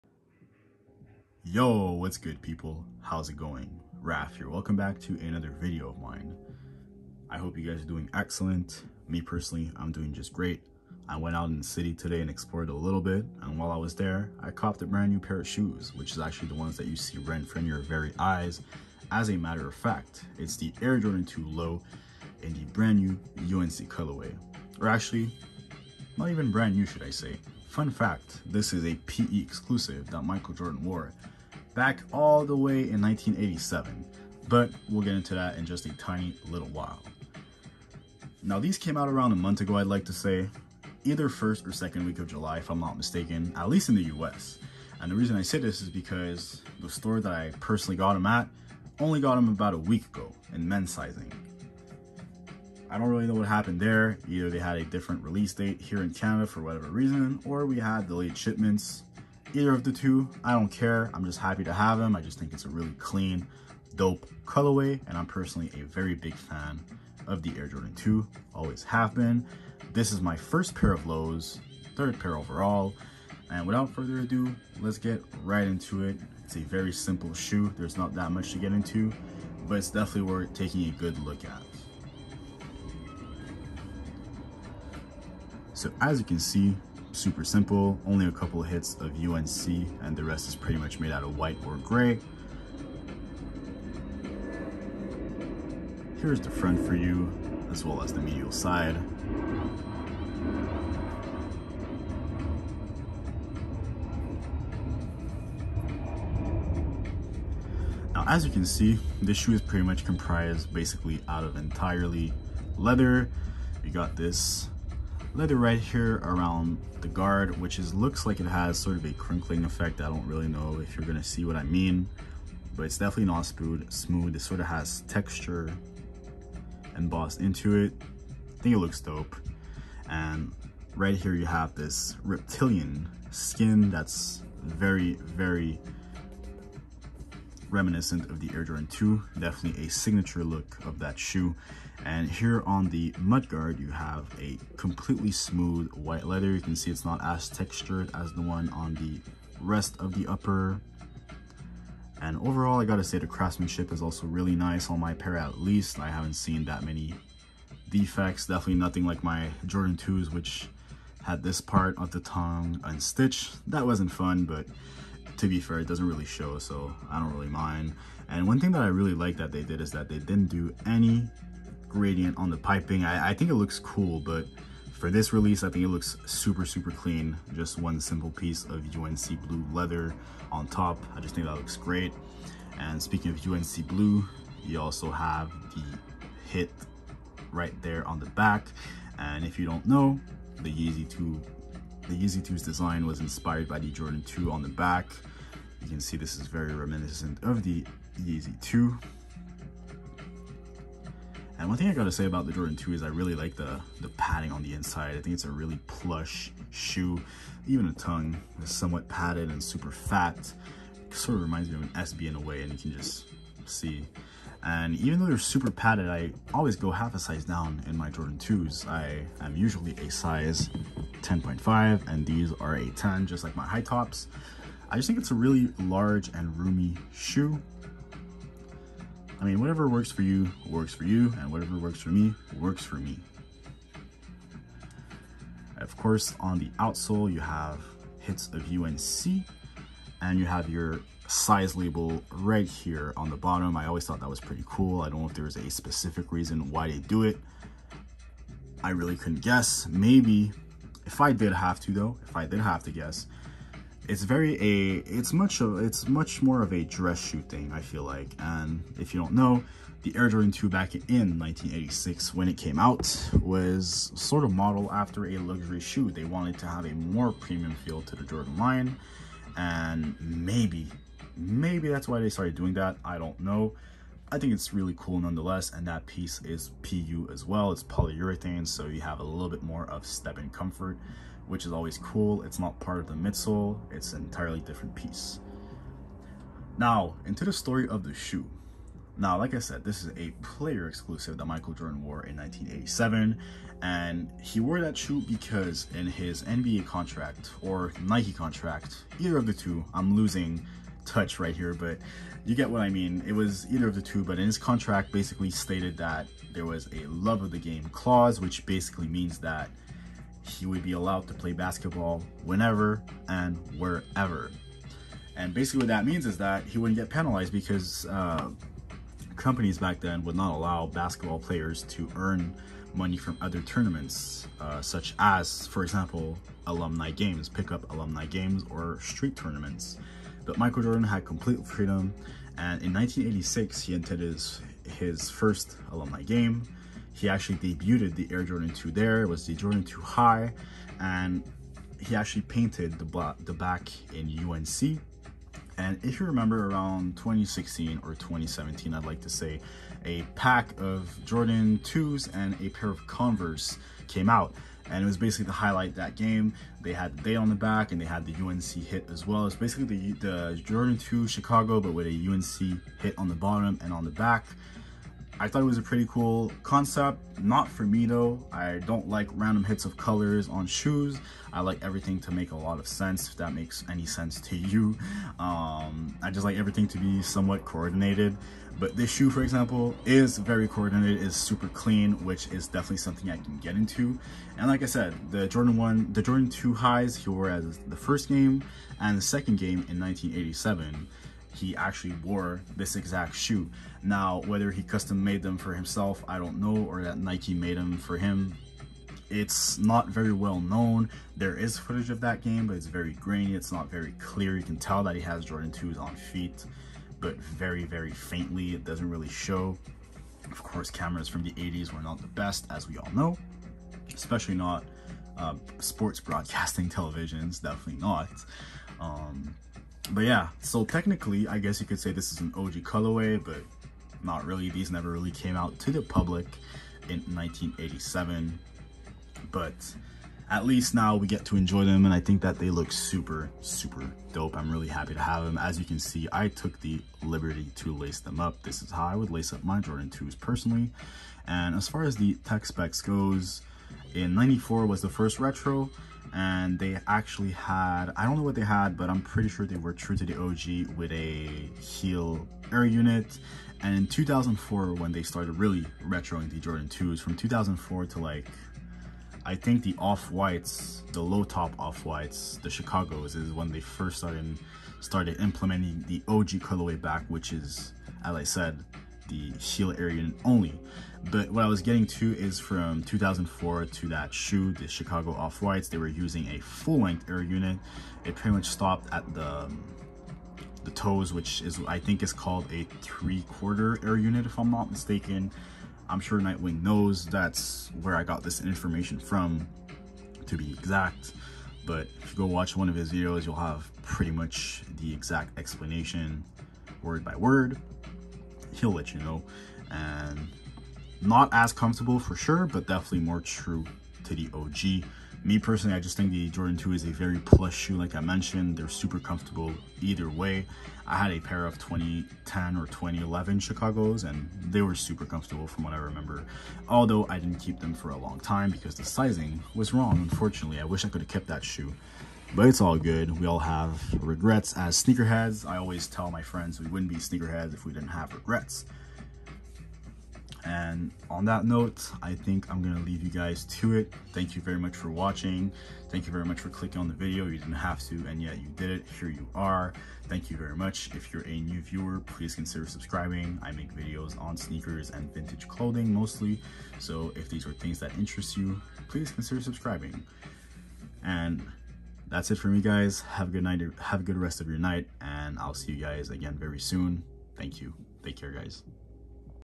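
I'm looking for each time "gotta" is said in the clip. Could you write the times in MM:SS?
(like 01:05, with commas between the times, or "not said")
02:32, 03:21.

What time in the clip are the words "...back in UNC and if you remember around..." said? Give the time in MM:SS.
05:43.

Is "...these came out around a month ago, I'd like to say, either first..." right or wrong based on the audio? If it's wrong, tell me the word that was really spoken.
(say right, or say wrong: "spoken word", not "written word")
right.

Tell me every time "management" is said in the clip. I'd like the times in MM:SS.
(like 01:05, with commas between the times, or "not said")
not said.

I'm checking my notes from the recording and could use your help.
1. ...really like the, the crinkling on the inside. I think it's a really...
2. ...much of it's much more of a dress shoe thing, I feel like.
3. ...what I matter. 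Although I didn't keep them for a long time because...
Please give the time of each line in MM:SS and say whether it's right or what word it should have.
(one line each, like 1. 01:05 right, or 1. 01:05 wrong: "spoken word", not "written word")
1. 03:23 wrong: "padding", not "crinkling"
2. 04:15 right
3. 08:35 wrong: "remember", not "matter".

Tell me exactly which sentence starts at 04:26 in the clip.
They wanted to have a more premium feel to the Jordan line and maybe maybe that's why they started doing that.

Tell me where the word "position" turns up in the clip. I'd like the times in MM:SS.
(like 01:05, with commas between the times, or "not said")
not said.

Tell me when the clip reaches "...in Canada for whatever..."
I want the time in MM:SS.
00:56.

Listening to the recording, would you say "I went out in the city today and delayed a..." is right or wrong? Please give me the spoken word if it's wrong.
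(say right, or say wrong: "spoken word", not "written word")
wrong: "explored", not "delayed".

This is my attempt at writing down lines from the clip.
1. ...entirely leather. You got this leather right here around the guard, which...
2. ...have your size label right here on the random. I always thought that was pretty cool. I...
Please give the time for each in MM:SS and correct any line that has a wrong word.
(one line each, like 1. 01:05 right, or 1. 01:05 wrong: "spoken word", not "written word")
1. 01:51 right
2. 04:00 wrong: "bottom", not "random".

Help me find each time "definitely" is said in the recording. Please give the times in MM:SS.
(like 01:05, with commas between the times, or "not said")
01:19, 02:02, 02:19, 02:38, 06:22, 06:57, 08:22.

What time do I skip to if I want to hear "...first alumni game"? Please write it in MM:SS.
05:35.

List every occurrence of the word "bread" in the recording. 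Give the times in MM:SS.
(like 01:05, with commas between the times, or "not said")
not said.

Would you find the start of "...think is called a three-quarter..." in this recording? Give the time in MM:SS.
08:01.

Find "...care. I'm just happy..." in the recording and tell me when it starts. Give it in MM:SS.
01:00.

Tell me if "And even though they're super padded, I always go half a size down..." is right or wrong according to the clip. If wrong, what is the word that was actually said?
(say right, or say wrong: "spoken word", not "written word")
right.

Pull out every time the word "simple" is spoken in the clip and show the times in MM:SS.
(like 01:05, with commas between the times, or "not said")
01:16, 01:27, 02:57.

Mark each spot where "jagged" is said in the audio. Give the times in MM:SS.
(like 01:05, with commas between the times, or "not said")
not said.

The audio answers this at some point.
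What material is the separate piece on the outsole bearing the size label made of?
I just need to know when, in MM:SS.
04:37.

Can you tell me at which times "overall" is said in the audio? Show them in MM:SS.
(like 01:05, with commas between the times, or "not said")
01:12, 02:32.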